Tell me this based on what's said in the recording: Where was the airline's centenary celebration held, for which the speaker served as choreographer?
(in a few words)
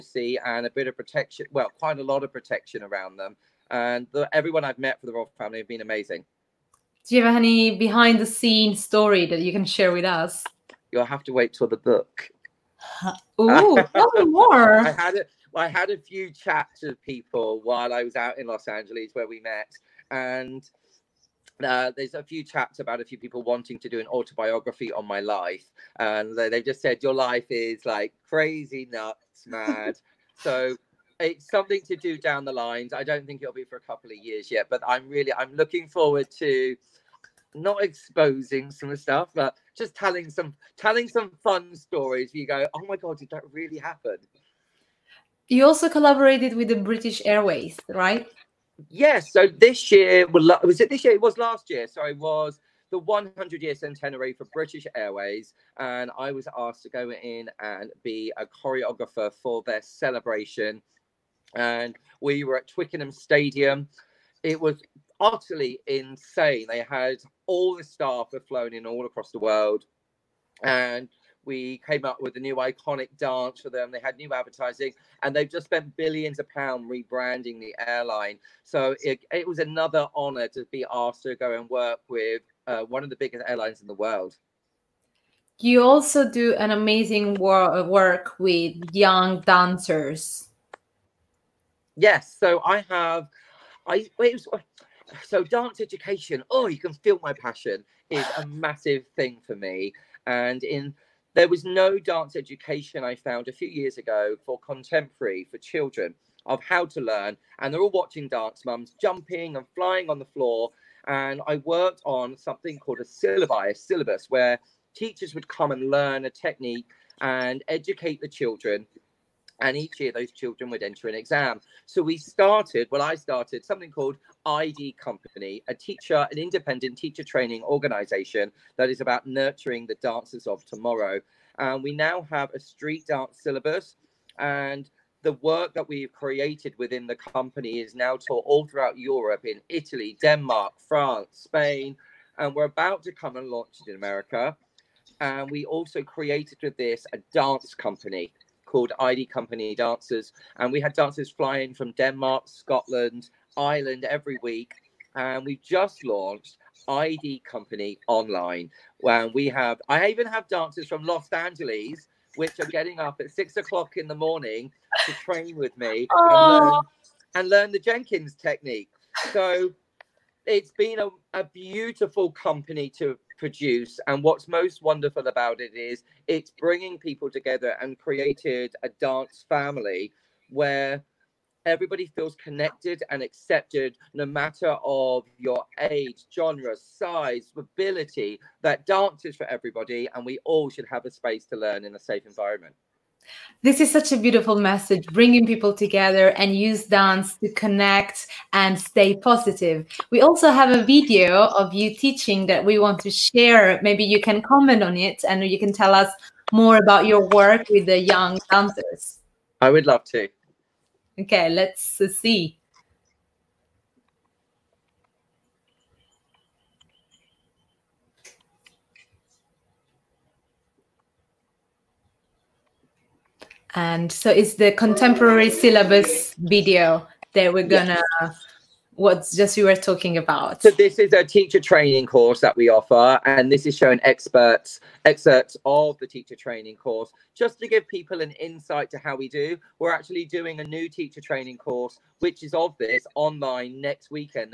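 Twickenham Stadium.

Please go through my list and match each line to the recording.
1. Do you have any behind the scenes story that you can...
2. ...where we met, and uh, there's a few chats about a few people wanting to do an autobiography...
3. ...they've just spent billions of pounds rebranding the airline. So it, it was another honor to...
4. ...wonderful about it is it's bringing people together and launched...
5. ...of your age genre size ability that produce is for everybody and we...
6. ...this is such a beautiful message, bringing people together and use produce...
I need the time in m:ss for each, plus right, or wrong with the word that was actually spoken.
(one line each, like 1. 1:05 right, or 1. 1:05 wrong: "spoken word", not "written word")
1. 0:07 right
2. 0:19 right
3. 1:15 right
4. 2:54 wrong: "created", not "launched"
5. 3:04 wrong: "dance", not "produce"
6. 3:13 wrong: "dance", not "produce".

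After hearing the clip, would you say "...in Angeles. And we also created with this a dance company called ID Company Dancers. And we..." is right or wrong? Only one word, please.
wrong.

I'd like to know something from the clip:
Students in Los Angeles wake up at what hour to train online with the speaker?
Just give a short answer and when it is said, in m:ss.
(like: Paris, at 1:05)
6 o'clock, at 2:43.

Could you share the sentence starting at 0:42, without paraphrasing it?
You go, oh my god, did that really happen?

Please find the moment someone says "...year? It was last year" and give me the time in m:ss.
0:51.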